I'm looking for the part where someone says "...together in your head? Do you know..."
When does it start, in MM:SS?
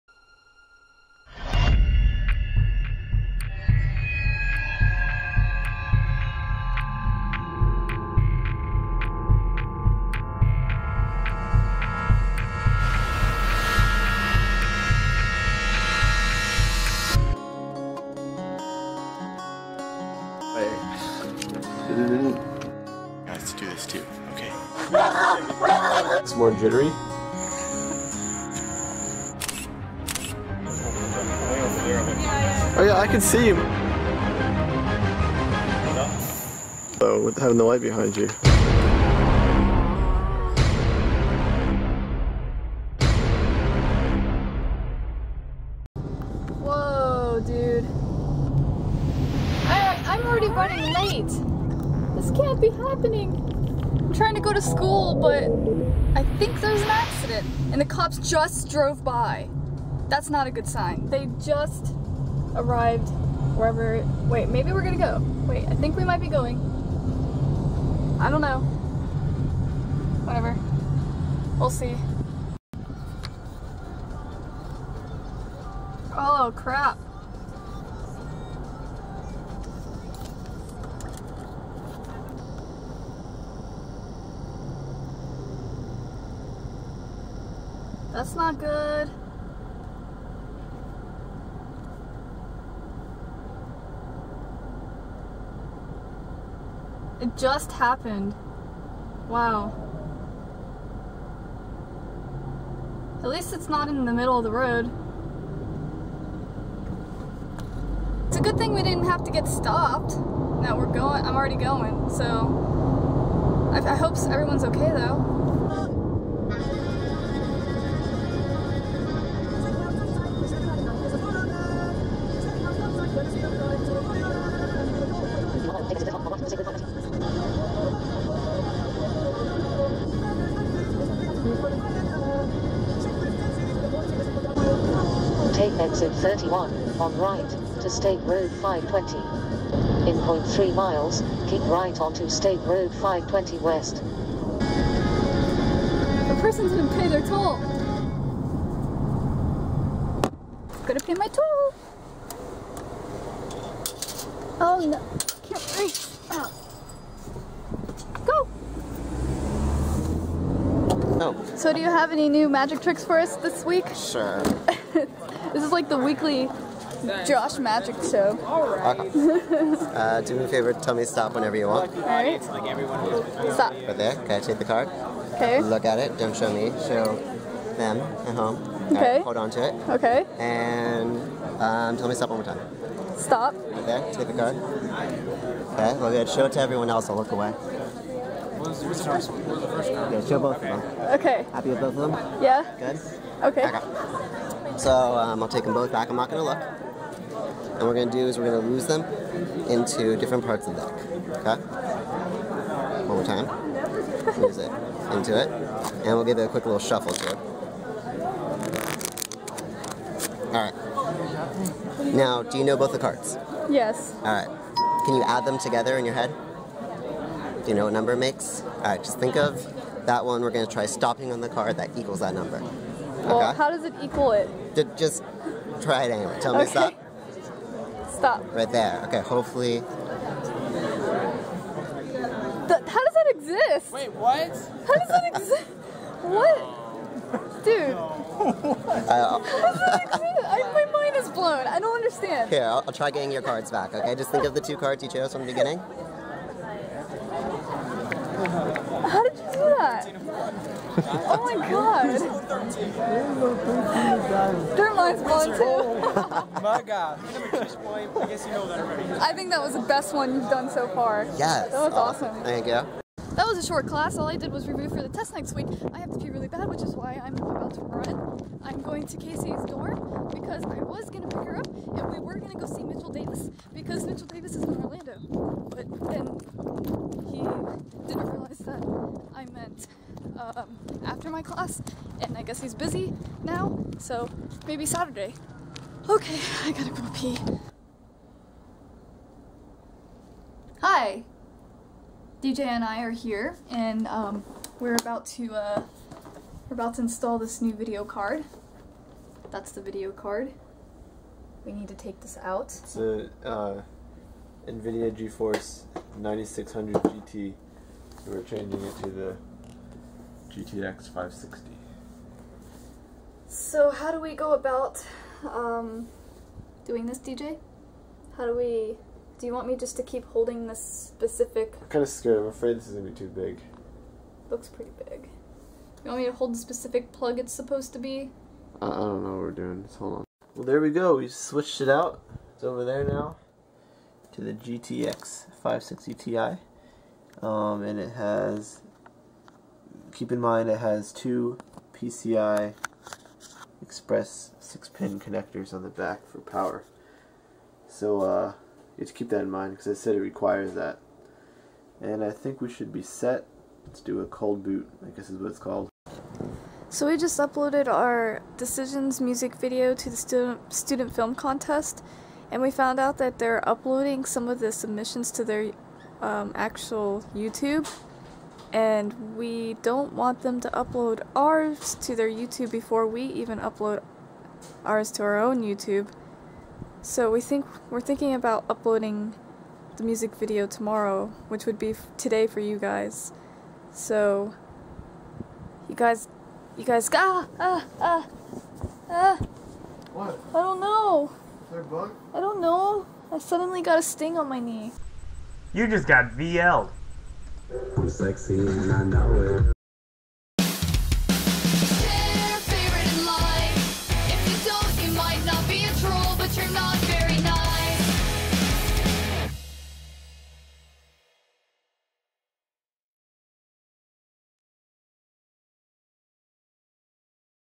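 03:35.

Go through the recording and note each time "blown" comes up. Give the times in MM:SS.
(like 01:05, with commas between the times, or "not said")
04:01, 04:15.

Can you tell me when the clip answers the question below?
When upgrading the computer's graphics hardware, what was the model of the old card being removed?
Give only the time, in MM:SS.
05:04.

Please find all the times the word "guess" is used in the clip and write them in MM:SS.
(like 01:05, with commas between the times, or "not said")
04:18, 04:42, 05:55.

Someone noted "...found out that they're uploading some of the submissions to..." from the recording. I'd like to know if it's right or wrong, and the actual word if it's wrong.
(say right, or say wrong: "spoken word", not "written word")
right.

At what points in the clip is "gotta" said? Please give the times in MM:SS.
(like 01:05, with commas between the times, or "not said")
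02:30, 04:46.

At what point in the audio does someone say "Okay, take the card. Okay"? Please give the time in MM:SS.
02:54.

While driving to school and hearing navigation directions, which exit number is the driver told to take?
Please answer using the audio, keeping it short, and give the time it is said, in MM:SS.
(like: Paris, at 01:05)
31, at 02:15.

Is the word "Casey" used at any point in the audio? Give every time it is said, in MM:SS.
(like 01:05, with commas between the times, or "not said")
04:29.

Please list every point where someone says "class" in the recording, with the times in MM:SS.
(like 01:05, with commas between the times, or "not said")
04:23, 04:41.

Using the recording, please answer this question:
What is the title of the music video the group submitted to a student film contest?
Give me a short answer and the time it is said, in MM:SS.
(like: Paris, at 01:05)
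Decisions, at 05:58.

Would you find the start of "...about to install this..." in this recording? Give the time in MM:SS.
04:56.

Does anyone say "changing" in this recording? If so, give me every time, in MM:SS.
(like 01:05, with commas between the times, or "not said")
05:08.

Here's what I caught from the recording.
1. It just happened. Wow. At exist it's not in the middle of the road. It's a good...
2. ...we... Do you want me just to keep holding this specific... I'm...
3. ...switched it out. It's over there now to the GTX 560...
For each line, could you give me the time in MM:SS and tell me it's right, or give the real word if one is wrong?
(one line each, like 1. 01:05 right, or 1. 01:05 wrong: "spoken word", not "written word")
1. 01:37 wrong: "least", not "exist"
2. 05:18 right
3. 05:31 right.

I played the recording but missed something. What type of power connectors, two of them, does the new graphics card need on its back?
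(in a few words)
PCI Express 6-pin.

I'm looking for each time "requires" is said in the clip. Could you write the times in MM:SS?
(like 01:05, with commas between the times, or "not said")
05:50.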